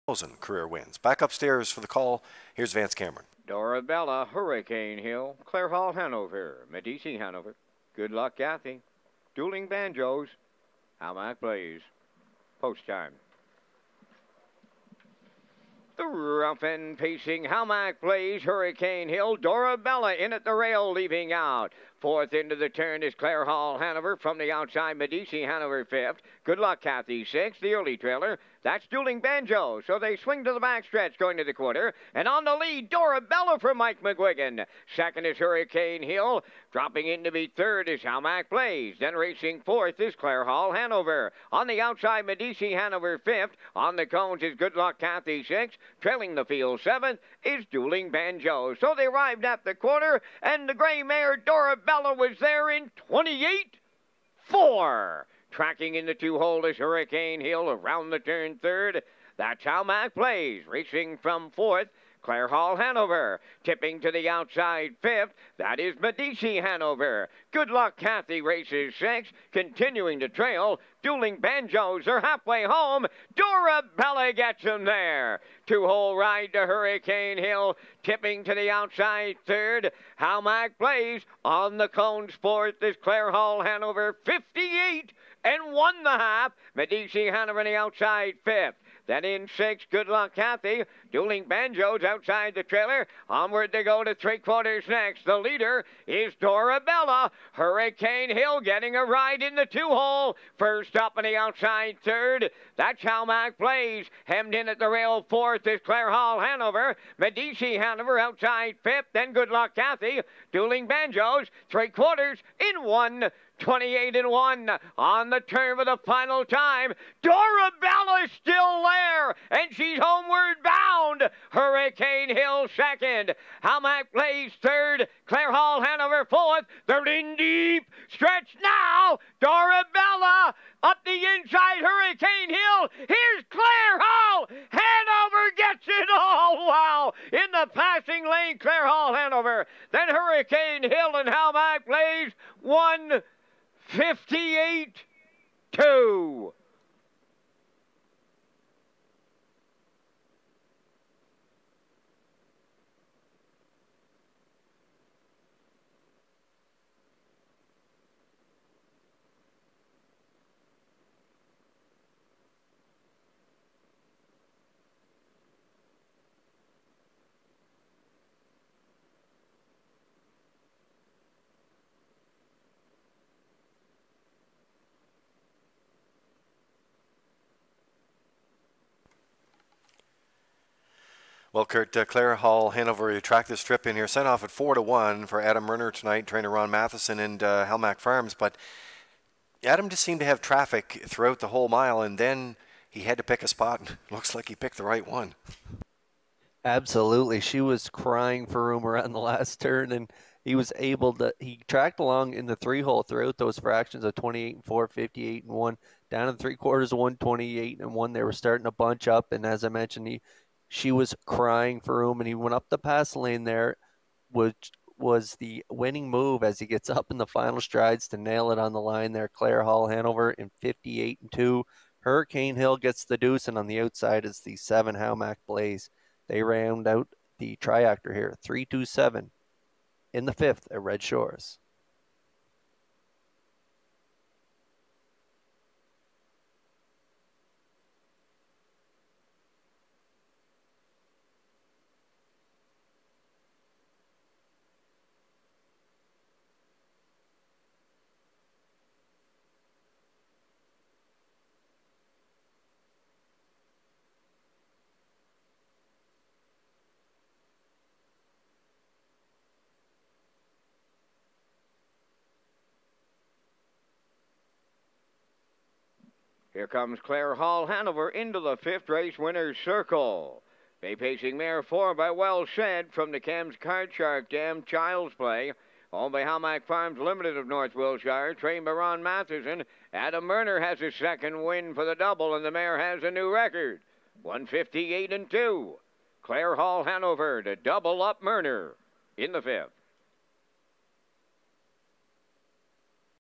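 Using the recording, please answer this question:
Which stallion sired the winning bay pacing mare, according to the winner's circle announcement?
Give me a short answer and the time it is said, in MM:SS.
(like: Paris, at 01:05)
Well Said, at 04:32.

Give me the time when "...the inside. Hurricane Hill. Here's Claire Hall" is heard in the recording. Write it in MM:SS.
02:11.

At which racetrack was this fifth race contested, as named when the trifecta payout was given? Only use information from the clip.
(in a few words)
Red Shores.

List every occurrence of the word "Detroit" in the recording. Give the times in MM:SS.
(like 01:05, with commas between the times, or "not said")
not said.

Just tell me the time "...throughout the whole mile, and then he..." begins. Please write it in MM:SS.
03:11.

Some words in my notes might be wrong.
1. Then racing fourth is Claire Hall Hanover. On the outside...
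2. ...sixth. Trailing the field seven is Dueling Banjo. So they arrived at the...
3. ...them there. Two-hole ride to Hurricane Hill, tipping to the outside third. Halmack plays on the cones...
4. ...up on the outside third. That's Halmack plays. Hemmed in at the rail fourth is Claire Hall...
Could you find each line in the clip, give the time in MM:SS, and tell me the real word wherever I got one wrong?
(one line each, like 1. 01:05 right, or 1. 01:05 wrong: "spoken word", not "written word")
1. 00:38 right
2. 00:45 right
3. 01:14 right
4. 01:40 right.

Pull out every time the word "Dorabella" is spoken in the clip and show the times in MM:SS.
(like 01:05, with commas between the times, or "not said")
00:03, 00:19, 00:32, 00:51, 01:36, 01:57, 02:09.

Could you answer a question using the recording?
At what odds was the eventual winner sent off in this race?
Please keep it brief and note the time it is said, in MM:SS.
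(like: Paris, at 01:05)
4 to 1, at 03:04.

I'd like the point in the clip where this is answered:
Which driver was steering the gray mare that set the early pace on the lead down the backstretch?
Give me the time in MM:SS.
00:33.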